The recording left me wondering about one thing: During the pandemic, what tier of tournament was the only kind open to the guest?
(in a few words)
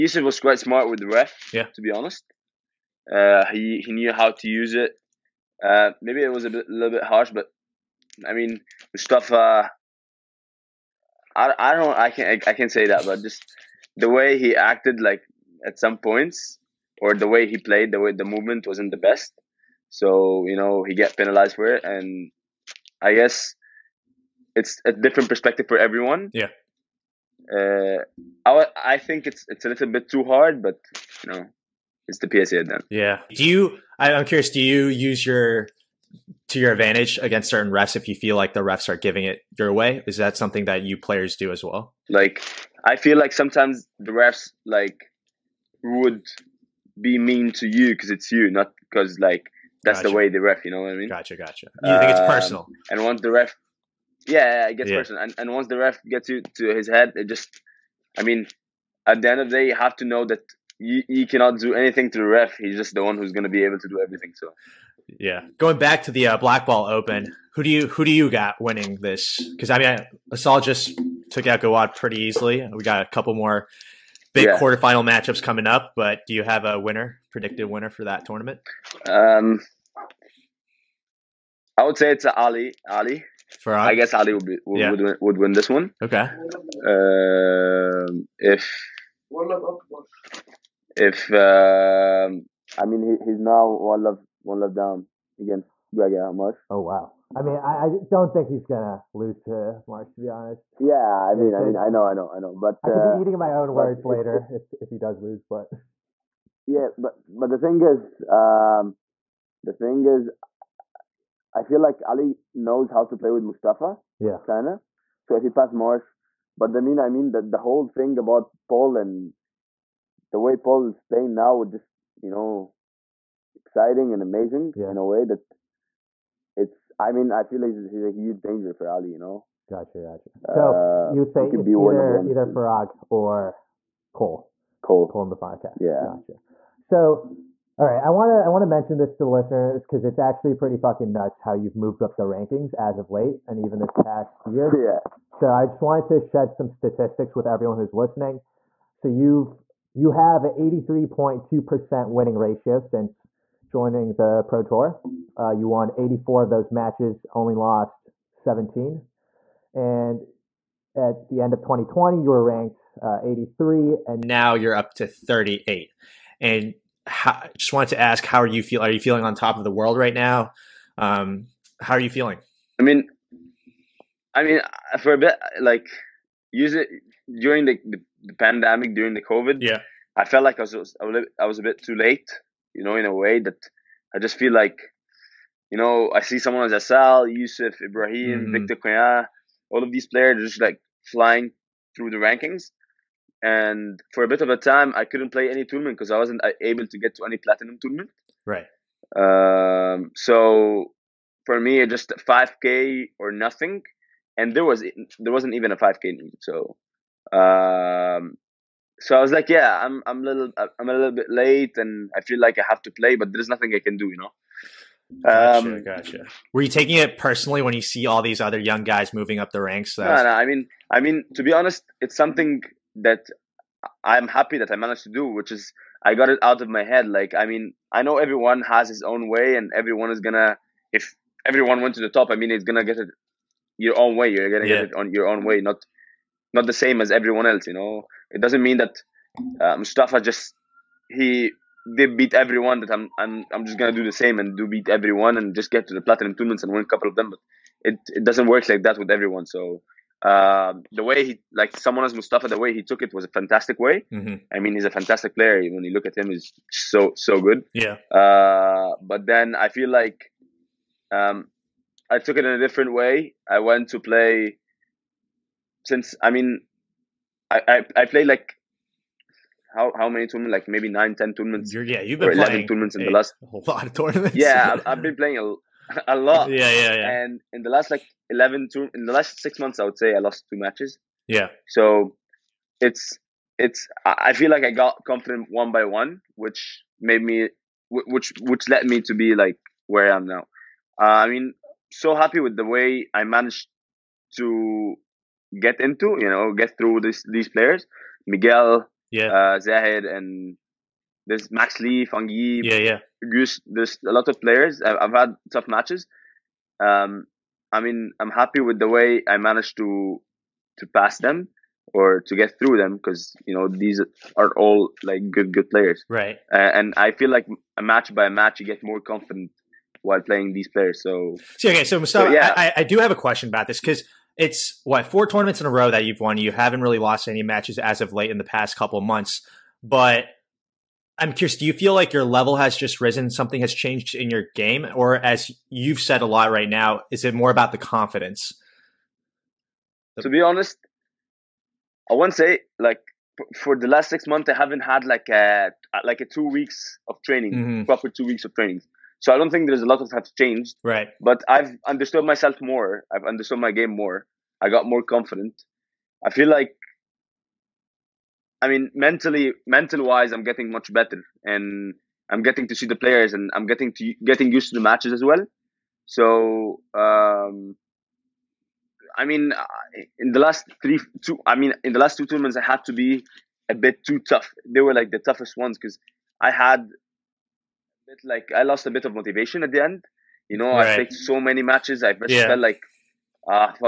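5K.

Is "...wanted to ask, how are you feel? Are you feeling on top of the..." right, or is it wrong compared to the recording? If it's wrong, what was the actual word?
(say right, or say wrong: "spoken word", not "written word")
right.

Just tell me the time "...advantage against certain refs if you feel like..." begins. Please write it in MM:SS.
00:36.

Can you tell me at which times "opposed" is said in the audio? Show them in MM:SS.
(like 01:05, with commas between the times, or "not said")
not said.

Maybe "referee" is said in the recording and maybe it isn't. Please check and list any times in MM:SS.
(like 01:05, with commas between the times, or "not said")
not said.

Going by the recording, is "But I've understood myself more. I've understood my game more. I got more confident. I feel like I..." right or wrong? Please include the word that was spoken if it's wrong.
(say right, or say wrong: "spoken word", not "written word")
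right.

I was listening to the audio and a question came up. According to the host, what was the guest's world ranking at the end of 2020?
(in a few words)
83.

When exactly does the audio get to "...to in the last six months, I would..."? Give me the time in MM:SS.
04:38.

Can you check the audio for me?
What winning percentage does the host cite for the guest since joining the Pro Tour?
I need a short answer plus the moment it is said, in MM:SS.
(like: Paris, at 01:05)
83.2%, at 02:30.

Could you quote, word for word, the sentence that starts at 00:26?
Yeah uh, I, I think it's it's a little bit too hard, but you know, it's the PSA then.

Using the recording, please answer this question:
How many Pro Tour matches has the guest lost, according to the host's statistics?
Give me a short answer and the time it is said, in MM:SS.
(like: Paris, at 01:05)
17, at 02:37.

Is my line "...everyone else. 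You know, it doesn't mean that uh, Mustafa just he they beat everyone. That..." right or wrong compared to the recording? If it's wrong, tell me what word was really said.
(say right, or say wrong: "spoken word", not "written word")
right.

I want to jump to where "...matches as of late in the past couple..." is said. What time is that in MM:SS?
05:27.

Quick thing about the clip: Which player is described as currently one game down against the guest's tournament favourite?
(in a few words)
Gregor Marche.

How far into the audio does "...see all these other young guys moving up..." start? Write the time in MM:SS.
03:37.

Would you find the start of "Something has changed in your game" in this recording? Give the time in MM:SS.
05:33.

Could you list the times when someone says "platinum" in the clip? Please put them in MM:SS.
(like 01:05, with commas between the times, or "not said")
03:17, 04:06.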